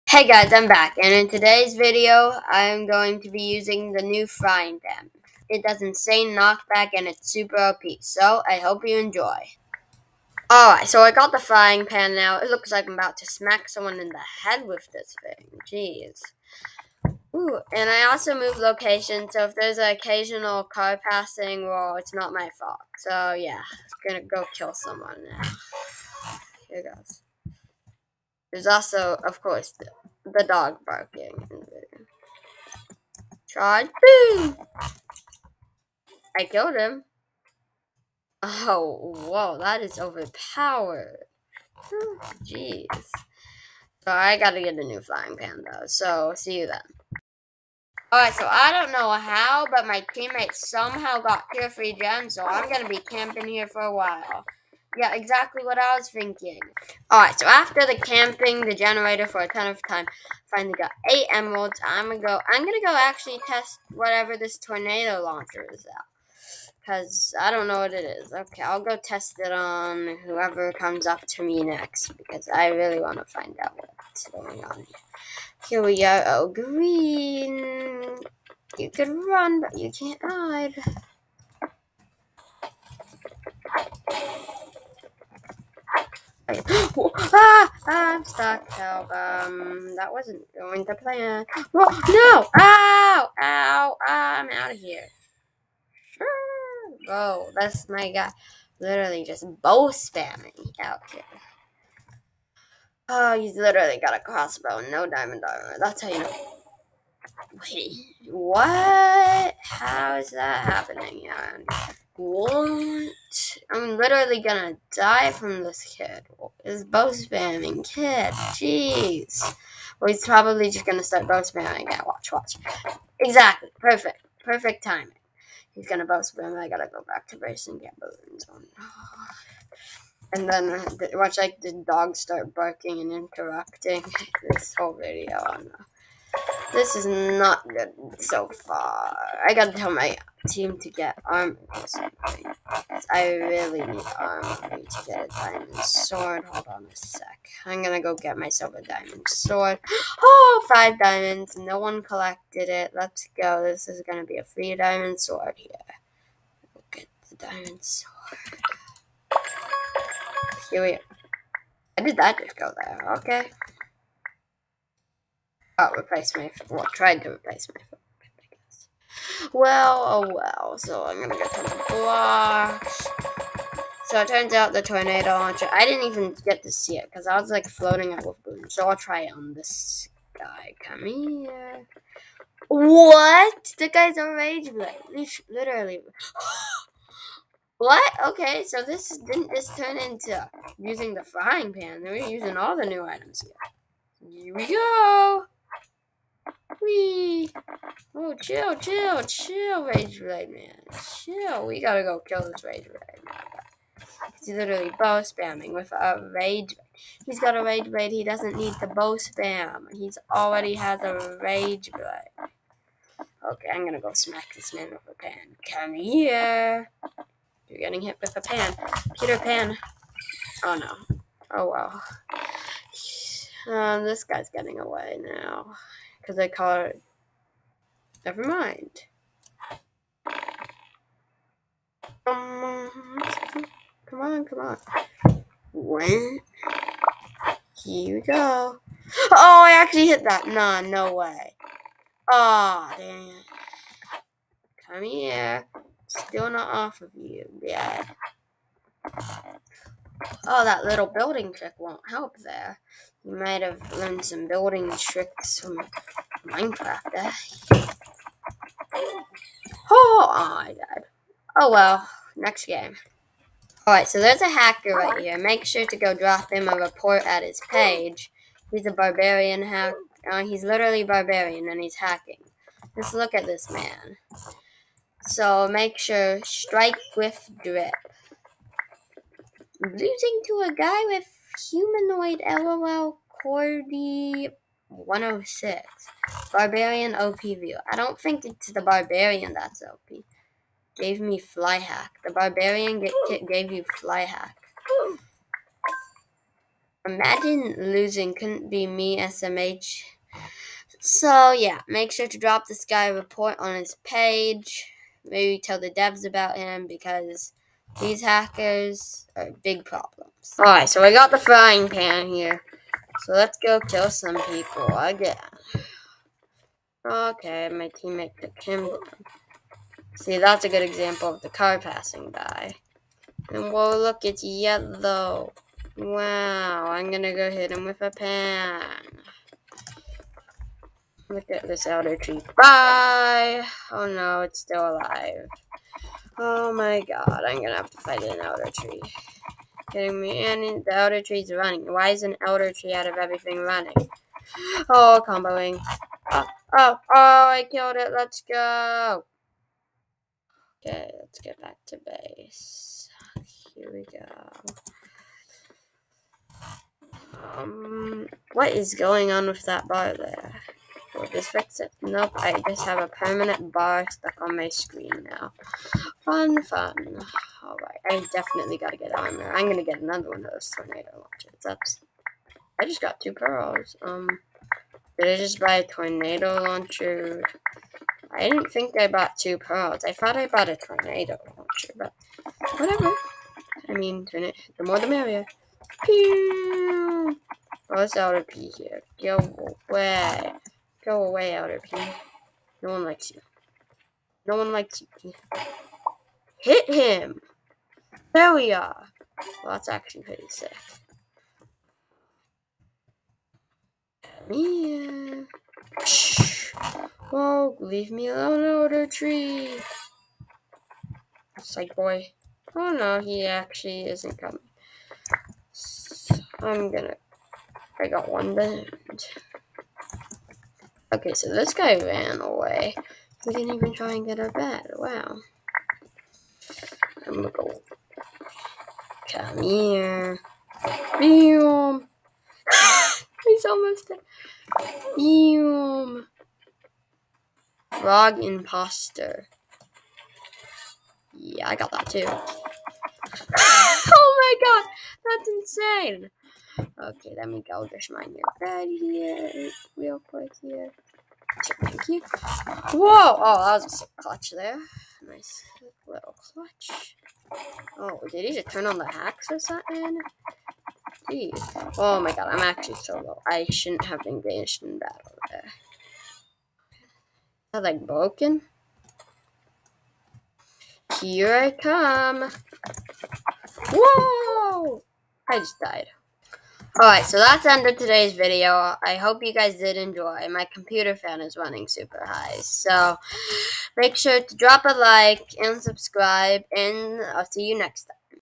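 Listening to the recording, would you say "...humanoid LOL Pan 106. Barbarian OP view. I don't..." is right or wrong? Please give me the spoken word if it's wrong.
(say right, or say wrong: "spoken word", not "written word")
wrong: "Cordy", not "Pan".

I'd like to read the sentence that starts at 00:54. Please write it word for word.
Yeah, exactly what I was thinking.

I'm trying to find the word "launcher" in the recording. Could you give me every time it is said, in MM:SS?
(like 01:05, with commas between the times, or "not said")
01:05, 02:55, 06:11, 06:16, 06:21.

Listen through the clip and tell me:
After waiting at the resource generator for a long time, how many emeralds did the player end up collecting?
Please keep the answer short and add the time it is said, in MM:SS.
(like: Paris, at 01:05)
8, at 01:01.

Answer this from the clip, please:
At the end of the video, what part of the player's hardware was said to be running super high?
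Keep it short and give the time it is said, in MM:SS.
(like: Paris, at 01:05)
computer fan, at 08:00.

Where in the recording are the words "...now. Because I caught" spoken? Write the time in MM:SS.
03:45.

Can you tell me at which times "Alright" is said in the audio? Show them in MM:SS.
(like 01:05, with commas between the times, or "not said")
00:10, 00:48, 00:57, 04:23, 05:10, 06:07, 07:57.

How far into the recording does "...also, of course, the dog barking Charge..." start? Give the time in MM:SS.
00:28.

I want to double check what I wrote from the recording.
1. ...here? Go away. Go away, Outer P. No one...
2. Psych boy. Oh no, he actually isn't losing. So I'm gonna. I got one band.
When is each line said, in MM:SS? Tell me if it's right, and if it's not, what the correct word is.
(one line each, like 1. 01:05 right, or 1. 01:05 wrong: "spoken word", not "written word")
1. 06:28 right
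2. 06:51 wrong: "coming", not "losing".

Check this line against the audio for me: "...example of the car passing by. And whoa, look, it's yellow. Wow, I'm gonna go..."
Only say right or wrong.
right.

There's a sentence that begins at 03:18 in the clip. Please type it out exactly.
Oh, chill, chill, chill, Rage Blade Man.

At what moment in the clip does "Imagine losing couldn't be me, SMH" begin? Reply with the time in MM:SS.
04:57.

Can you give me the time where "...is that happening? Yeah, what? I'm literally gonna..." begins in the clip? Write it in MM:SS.
01:50.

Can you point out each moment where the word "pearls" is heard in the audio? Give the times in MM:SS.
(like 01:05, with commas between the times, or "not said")
06:13, 06:19.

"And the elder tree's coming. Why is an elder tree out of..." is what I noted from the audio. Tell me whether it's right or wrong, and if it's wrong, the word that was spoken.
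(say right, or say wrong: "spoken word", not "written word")
wrong: "running", not "coming".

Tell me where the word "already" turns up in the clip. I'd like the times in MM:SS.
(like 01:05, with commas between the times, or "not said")
03:30.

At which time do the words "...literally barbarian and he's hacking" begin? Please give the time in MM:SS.
04:30.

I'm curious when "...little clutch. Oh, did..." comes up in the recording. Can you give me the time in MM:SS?
07:36.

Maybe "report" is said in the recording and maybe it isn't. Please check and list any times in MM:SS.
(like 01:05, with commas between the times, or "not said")
04:26, 05:03.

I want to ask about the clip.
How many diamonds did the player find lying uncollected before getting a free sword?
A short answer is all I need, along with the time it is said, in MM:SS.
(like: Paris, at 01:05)
5, at 02:30.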